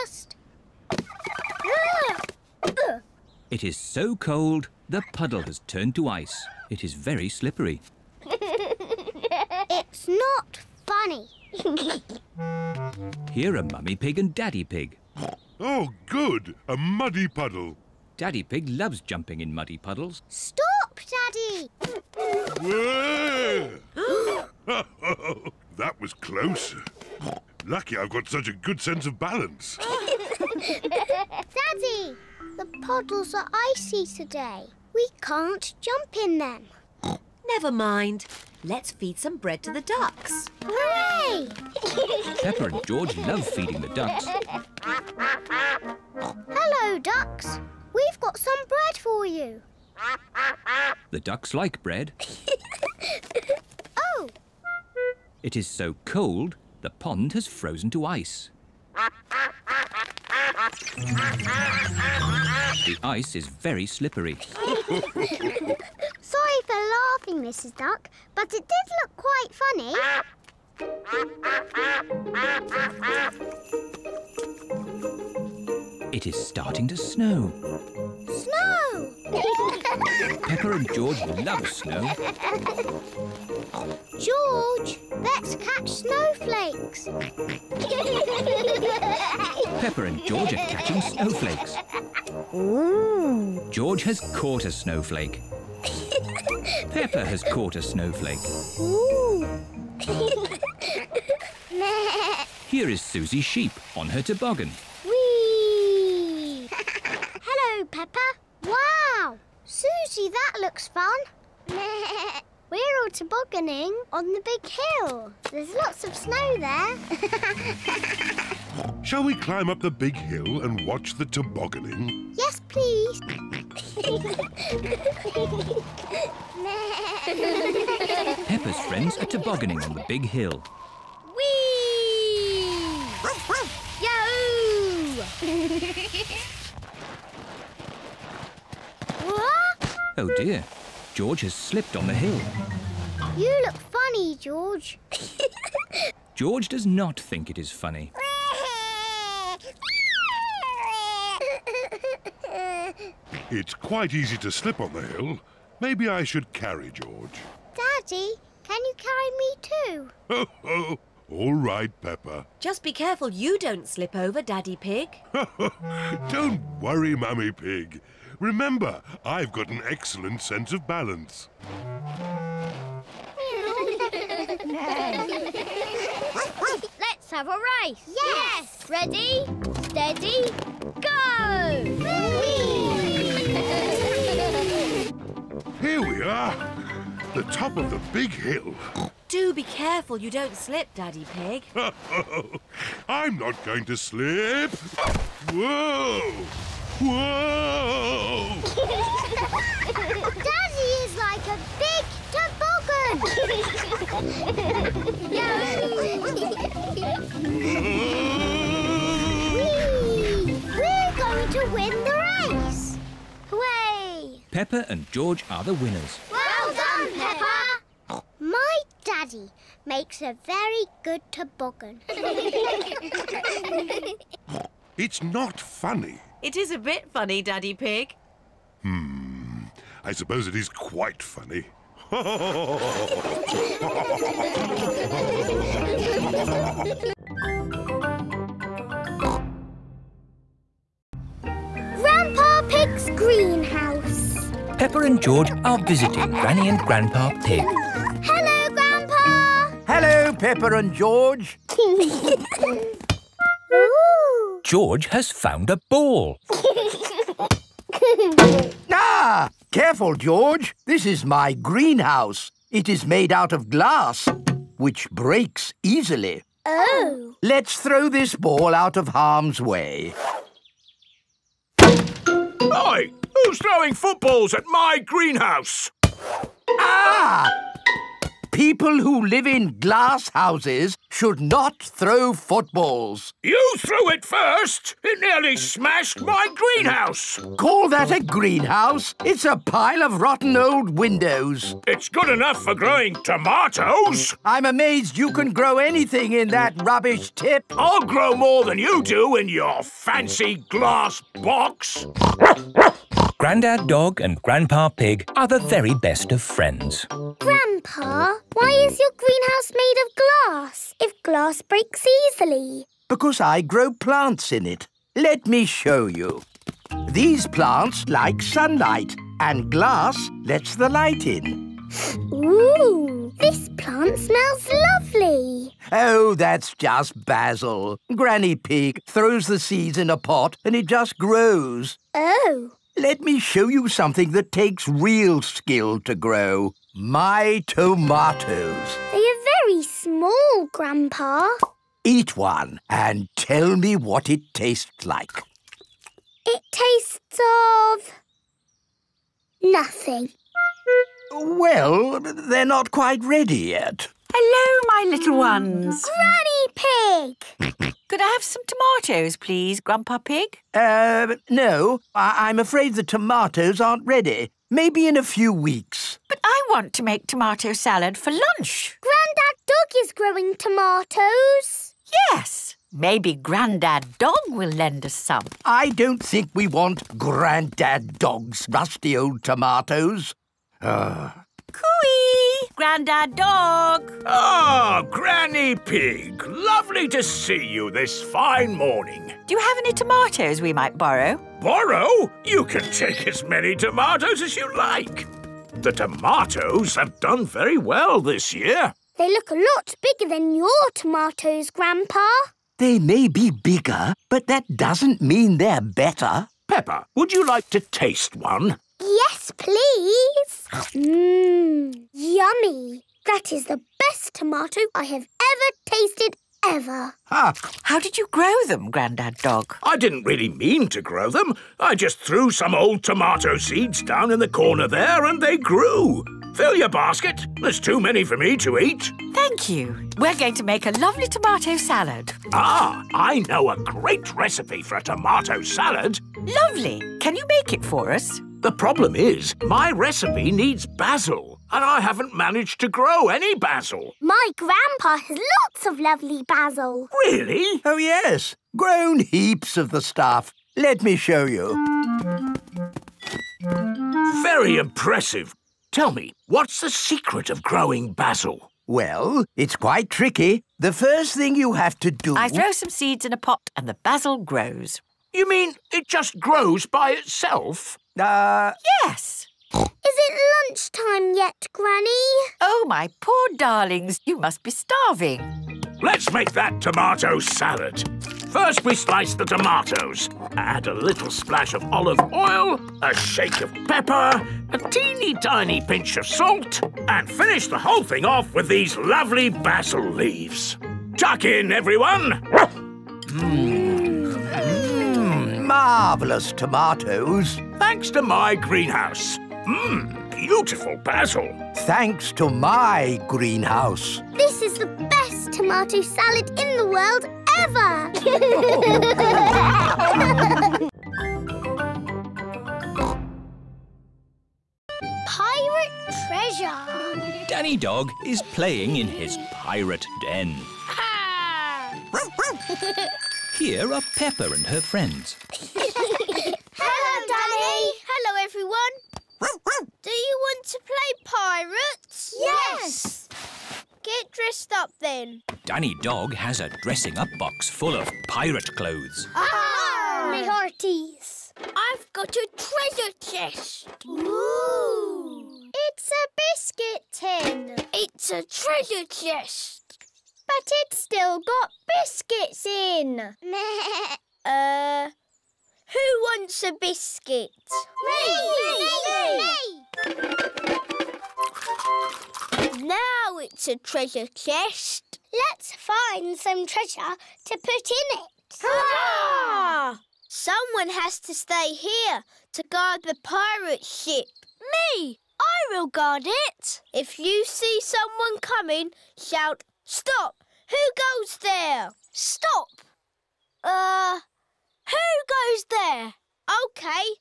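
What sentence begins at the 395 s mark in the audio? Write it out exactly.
The tomatoes have done very well this year.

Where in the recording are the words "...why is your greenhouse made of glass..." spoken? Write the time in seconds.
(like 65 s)
308 s.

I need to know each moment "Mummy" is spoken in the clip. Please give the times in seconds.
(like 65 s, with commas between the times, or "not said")
13 s, 167 s.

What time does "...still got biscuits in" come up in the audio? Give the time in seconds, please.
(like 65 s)
550 s.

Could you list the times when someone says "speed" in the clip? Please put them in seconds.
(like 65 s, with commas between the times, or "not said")
not said.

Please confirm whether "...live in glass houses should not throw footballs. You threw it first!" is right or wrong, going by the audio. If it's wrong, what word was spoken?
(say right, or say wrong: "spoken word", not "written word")
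right.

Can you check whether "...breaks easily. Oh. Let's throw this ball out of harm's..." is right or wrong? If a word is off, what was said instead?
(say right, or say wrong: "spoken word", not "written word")
right.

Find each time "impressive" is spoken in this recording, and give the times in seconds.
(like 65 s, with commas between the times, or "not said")
454 s.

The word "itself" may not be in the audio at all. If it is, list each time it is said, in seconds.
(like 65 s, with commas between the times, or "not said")
467 s.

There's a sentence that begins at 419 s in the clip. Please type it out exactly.
I didn't really mean to grow them.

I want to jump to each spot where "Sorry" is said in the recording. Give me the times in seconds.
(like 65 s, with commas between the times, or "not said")
64 s.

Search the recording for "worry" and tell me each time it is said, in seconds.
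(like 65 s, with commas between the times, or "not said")
166 s.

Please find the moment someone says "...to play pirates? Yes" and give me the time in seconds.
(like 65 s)
530 s.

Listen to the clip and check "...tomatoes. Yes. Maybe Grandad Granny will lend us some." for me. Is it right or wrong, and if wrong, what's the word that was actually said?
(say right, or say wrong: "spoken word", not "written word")
wrong: "Dog", not "Granny".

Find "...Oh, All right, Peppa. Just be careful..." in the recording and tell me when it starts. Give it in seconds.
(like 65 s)
160 s.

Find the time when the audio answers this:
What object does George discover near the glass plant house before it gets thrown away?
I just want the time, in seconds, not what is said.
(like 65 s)
254 s.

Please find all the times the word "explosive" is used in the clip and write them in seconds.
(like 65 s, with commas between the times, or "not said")
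not said.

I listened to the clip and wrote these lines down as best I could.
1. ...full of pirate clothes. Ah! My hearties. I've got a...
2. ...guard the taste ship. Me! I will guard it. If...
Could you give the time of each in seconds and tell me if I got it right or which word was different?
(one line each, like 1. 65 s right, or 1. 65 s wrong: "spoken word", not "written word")
1. 537 s right
2. 572 s wrong: "pirate", not "taste".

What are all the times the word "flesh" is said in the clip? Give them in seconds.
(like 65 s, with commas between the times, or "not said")
not said.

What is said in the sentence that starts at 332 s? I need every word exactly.
Oh, let me show you something that takes real skill to grow.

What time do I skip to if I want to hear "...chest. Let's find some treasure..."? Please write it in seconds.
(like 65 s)
564 s.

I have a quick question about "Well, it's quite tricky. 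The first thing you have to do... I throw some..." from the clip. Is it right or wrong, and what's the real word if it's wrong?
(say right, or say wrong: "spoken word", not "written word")
right.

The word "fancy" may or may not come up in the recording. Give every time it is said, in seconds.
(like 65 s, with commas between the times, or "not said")
299 s.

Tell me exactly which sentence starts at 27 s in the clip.
Lucky I've got such a good sense of balance.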